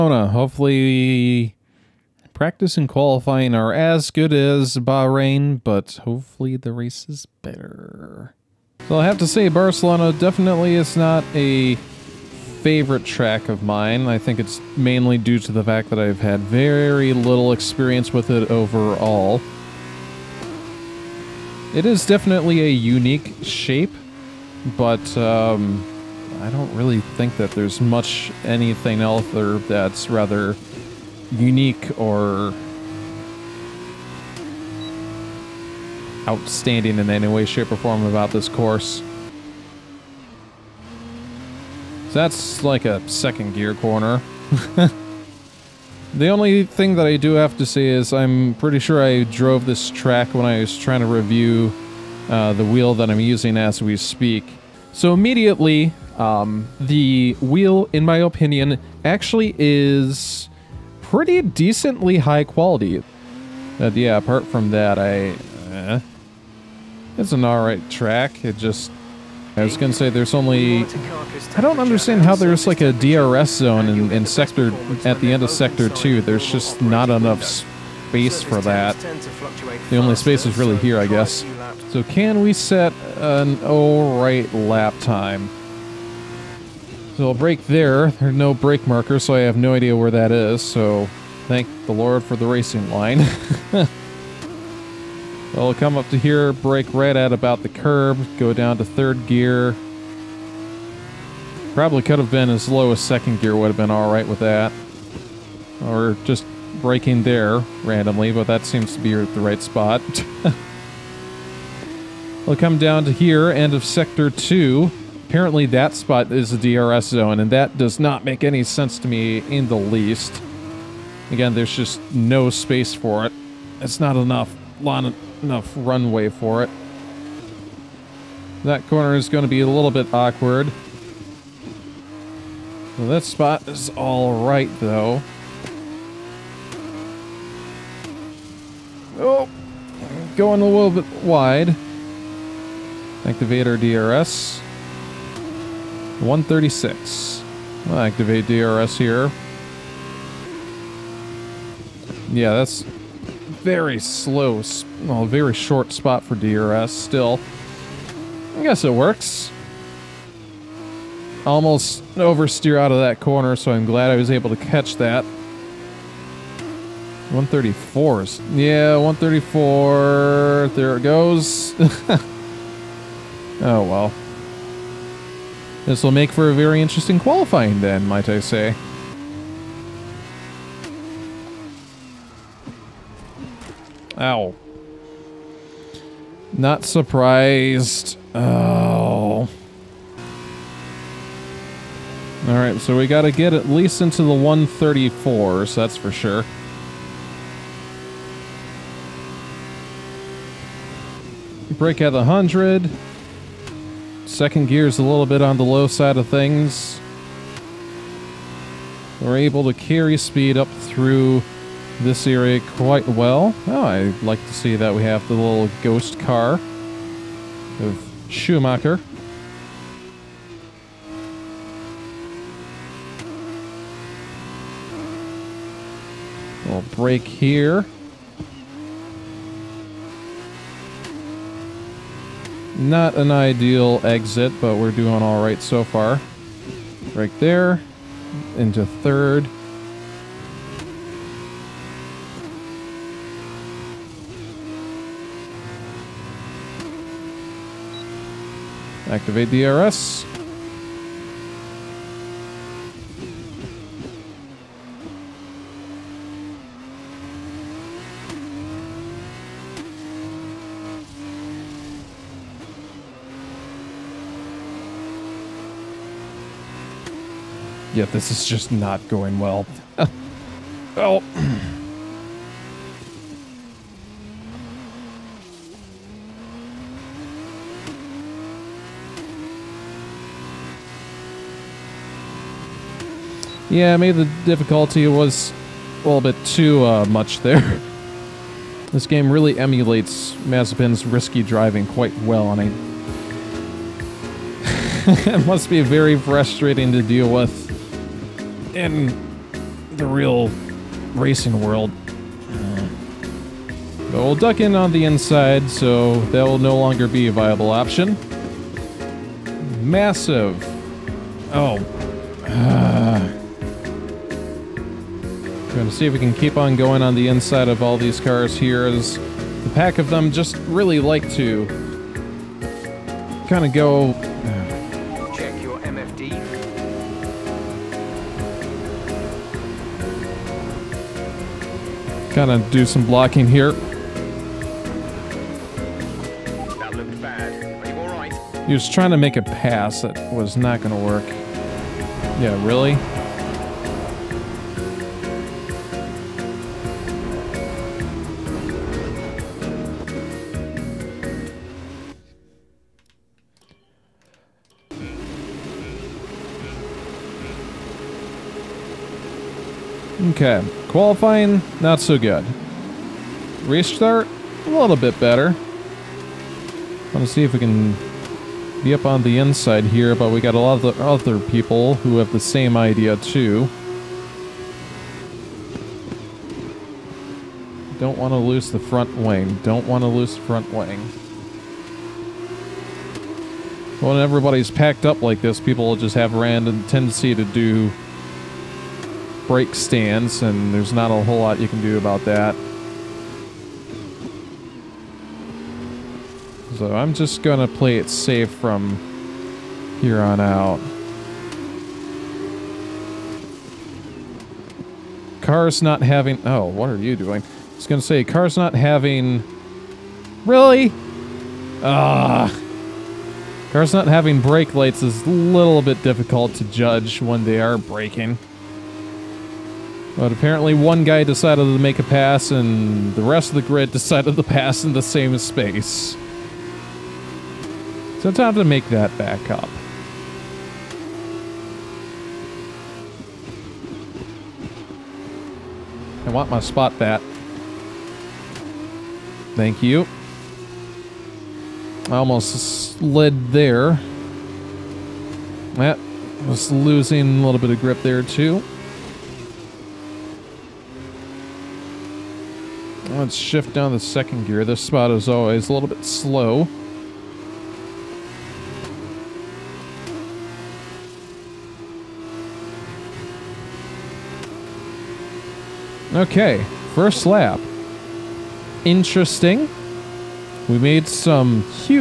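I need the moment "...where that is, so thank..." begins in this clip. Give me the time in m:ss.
1:29.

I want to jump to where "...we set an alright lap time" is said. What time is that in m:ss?
1:22.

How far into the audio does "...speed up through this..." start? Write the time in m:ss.
3:30.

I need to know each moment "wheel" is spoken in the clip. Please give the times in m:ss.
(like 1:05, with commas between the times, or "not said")
0:52, 0:57.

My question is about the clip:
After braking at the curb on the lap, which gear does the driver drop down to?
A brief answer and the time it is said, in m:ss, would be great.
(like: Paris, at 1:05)
Third gear, at 1:38.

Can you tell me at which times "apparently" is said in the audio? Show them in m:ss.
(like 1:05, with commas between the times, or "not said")
1:55, 7:00.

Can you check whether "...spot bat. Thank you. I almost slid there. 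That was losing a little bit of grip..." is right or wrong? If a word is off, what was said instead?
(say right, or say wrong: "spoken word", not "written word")
right.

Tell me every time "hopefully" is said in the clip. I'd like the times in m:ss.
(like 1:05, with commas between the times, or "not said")
0:00, 0:06.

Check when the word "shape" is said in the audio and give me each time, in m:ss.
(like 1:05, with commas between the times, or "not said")
0:23, 0:37.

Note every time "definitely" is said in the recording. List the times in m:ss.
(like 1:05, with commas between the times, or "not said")
0:10, 0:22.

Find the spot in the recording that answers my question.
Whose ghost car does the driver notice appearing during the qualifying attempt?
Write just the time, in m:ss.
3:38.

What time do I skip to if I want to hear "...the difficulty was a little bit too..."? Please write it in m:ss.
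4:44.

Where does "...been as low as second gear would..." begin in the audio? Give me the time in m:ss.
1:42.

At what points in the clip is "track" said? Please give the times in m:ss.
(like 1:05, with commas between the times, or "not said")
0:13, 0:49, 1:07.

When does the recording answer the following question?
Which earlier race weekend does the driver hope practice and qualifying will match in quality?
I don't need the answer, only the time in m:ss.
0:04.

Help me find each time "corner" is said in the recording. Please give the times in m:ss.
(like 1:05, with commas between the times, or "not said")
0:43, 2:08, 2:43.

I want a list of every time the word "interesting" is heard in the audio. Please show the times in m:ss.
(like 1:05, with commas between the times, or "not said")
2:56, 7:48.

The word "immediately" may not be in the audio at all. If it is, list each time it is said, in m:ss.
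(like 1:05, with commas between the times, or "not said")
0:55.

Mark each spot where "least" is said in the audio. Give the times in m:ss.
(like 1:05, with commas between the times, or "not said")
1:59, 3:13.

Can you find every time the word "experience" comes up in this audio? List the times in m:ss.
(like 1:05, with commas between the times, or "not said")
0:17.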